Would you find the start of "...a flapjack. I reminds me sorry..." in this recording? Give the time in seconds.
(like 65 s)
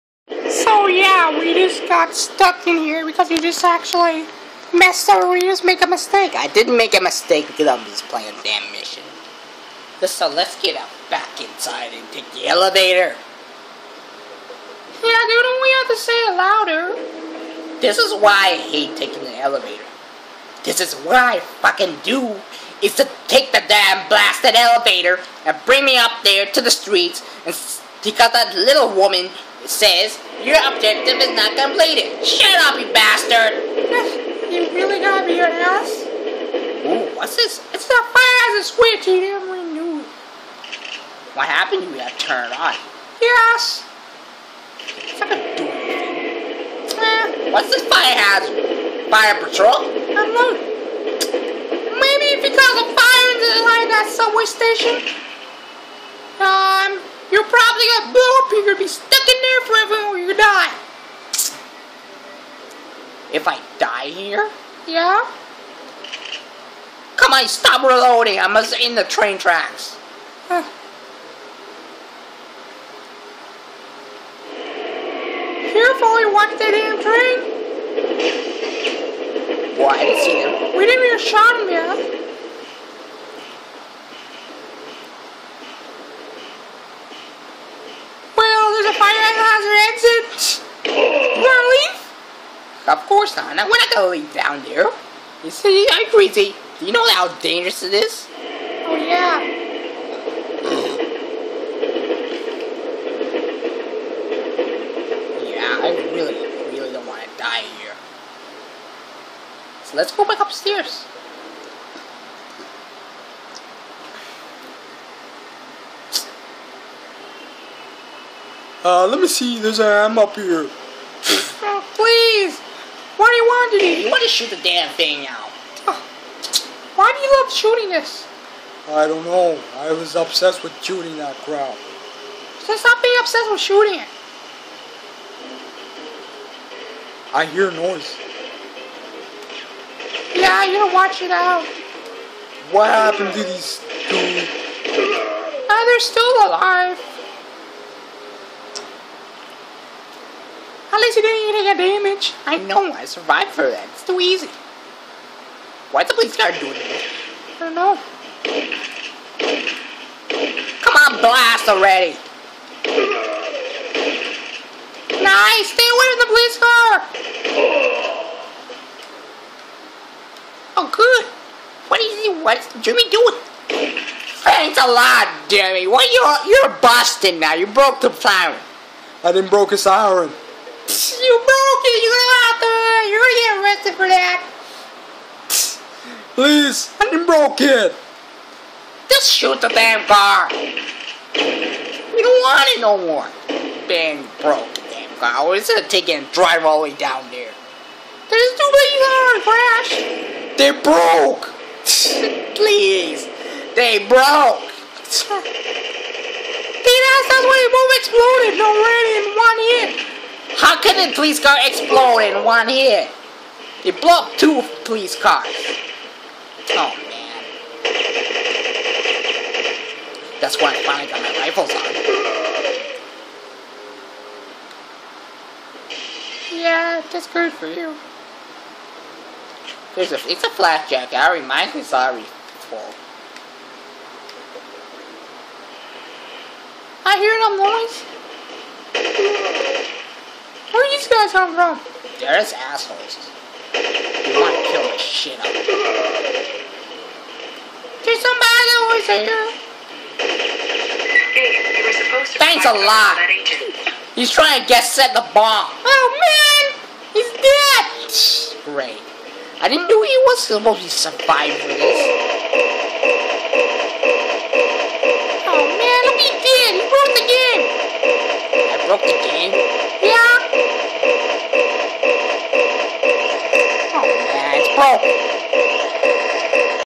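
230 s.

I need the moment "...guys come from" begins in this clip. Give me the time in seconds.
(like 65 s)
241 s.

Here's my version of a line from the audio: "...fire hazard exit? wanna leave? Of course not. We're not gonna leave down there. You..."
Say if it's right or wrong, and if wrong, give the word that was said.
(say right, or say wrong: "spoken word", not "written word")
right.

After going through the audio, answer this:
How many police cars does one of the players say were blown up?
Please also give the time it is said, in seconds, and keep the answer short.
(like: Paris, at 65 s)
2, at 214 s.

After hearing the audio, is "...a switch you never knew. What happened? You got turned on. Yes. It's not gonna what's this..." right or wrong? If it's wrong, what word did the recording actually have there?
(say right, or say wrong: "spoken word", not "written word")
right.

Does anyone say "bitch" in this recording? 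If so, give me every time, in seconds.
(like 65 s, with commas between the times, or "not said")
152 s.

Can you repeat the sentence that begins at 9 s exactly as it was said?
So let's get out back inside and take the elevator.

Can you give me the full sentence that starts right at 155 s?
Why'd the police guard doing this?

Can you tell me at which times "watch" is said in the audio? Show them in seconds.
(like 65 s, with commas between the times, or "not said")
76 s, 140 s.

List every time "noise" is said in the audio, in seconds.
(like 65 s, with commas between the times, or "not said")
137 s, 237 s.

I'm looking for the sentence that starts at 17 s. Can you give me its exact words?
This is why I hate taking the elevator.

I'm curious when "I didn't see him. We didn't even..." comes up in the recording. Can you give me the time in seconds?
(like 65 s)
79 s.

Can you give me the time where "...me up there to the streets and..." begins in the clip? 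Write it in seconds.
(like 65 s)
25 s.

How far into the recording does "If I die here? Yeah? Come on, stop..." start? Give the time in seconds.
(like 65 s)
63 s.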